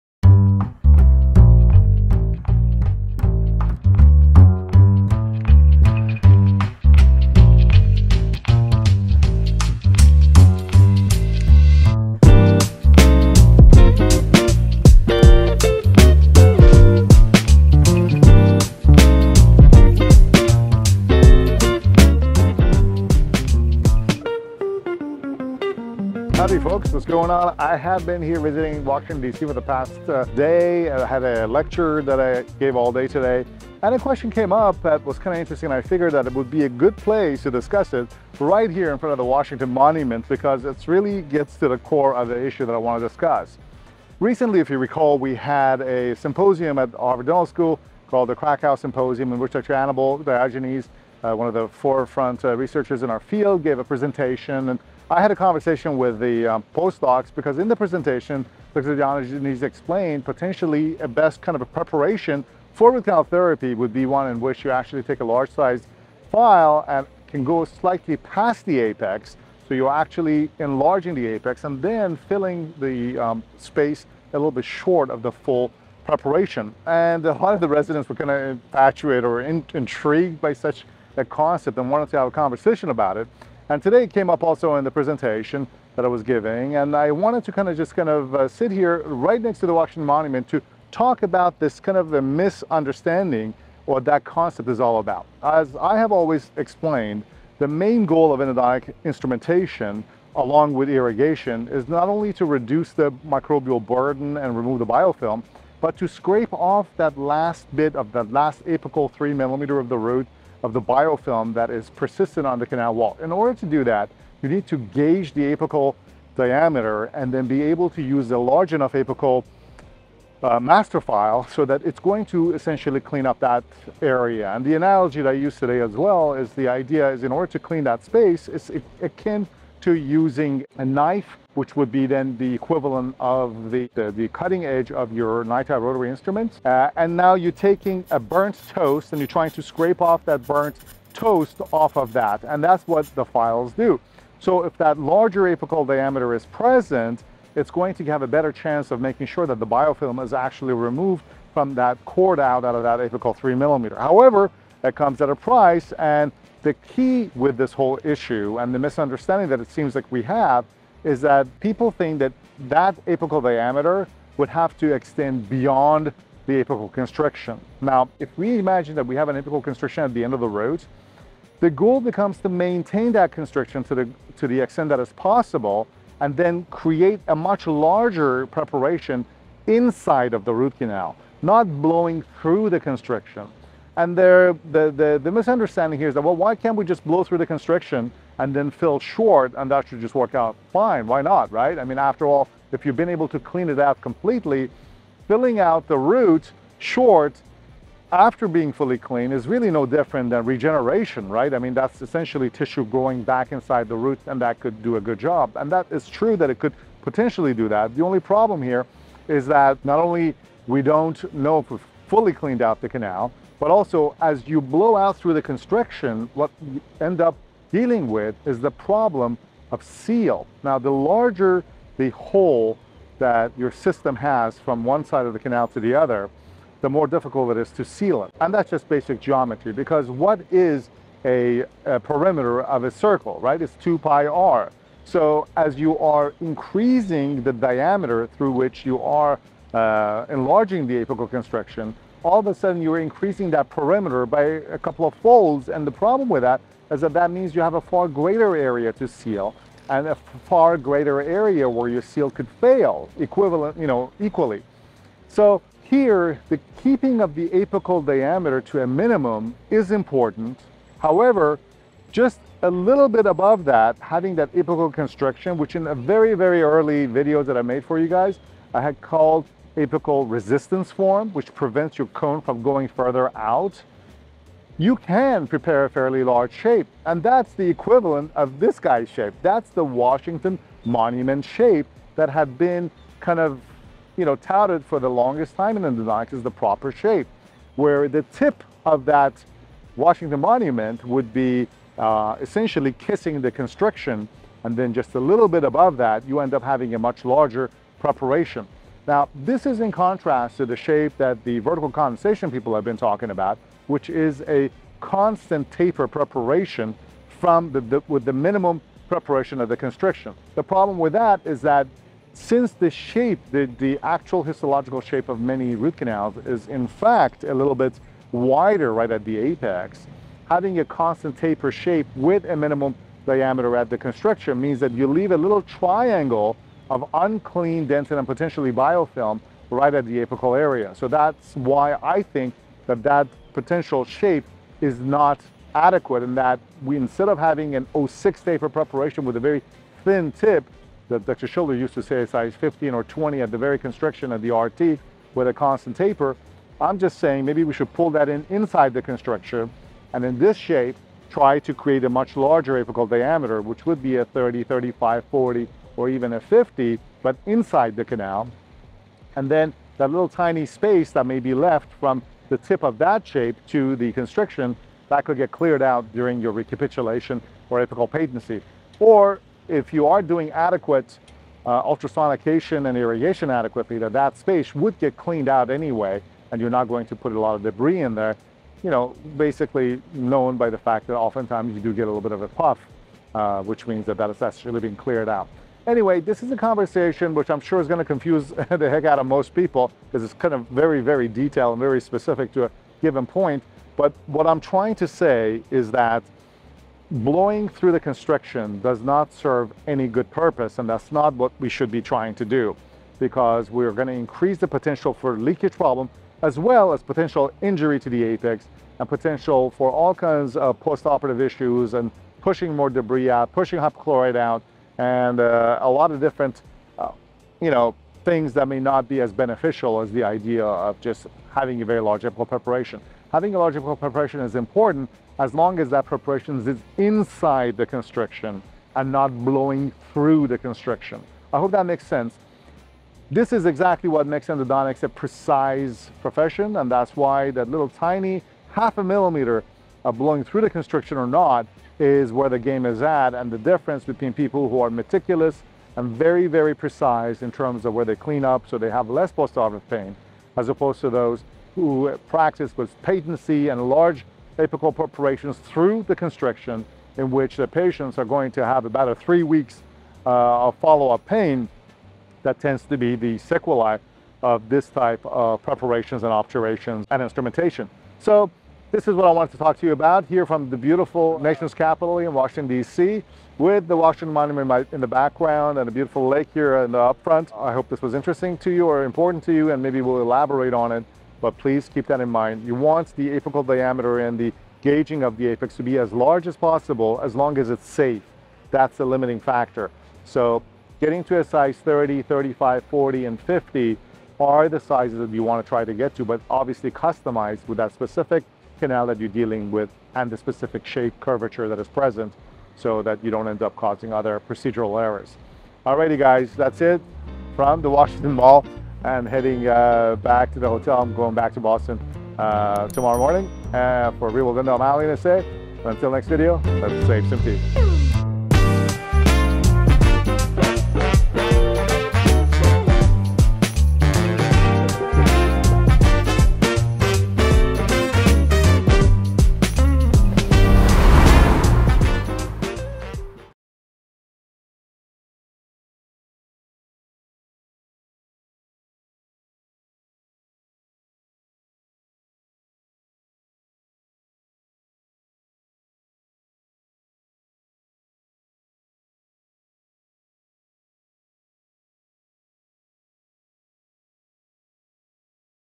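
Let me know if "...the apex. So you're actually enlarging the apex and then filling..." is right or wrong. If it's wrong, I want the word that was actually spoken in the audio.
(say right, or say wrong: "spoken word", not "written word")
right.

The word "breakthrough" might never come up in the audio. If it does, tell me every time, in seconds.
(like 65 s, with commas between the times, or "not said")
not said.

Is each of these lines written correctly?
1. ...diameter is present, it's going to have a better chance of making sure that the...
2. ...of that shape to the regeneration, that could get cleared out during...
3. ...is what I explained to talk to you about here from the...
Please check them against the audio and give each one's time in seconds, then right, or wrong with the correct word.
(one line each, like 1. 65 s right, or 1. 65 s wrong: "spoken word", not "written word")
1. 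145 s right
2. 362 s wrong: "constriction", not "regeneration"
3. 469 s wrong: "wanted", not "explained".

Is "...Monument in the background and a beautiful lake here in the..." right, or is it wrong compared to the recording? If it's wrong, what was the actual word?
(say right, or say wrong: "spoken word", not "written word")
right.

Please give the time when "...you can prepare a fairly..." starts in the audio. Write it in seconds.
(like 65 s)
274 s.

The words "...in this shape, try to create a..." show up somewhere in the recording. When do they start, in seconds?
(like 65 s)
350 s.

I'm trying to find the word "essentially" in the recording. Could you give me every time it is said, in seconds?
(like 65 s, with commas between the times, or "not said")
122 s, 202 s, 292 s.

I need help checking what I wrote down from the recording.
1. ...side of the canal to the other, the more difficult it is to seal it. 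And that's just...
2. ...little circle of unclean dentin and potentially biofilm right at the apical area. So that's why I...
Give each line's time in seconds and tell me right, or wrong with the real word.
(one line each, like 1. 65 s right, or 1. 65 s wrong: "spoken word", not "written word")
1. 225 s right
2. 325 s wrong: "triangle", not "circle".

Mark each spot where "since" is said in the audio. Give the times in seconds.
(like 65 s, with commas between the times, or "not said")
312 s.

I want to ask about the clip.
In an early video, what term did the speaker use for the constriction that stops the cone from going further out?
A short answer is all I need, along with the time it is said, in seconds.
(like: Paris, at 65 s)
apical resistance form, at 269 s.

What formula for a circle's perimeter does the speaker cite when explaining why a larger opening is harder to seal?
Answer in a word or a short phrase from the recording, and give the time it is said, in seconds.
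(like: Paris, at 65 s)
2 pi r, at 233 s.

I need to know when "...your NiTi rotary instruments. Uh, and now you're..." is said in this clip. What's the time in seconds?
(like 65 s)
135 s.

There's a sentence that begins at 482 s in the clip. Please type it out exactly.
You want the apical diameter and the gauging of the apex to be as large as possible as long as it's safe.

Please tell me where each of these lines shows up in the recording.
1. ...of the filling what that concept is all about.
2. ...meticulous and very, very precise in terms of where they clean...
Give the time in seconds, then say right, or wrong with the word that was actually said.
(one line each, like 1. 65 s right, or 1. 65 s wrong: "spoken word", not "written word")
1. 91 s wrong: "misunderstanding", not "filling"
2. 444 s right.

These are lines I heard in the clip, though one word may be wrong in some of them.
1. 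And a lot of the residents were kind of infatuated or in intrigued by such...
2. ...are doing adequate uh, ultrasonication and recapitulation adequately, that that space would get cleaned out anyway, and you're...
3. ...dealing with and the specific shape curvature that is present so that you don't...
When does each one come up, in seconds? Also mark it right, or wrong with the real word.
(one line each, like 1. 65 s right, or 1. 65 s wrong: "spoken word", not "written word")
1. 76 s right
2. 370 s wrong: "irrigation", not "recapitulation"
3. 499 s right.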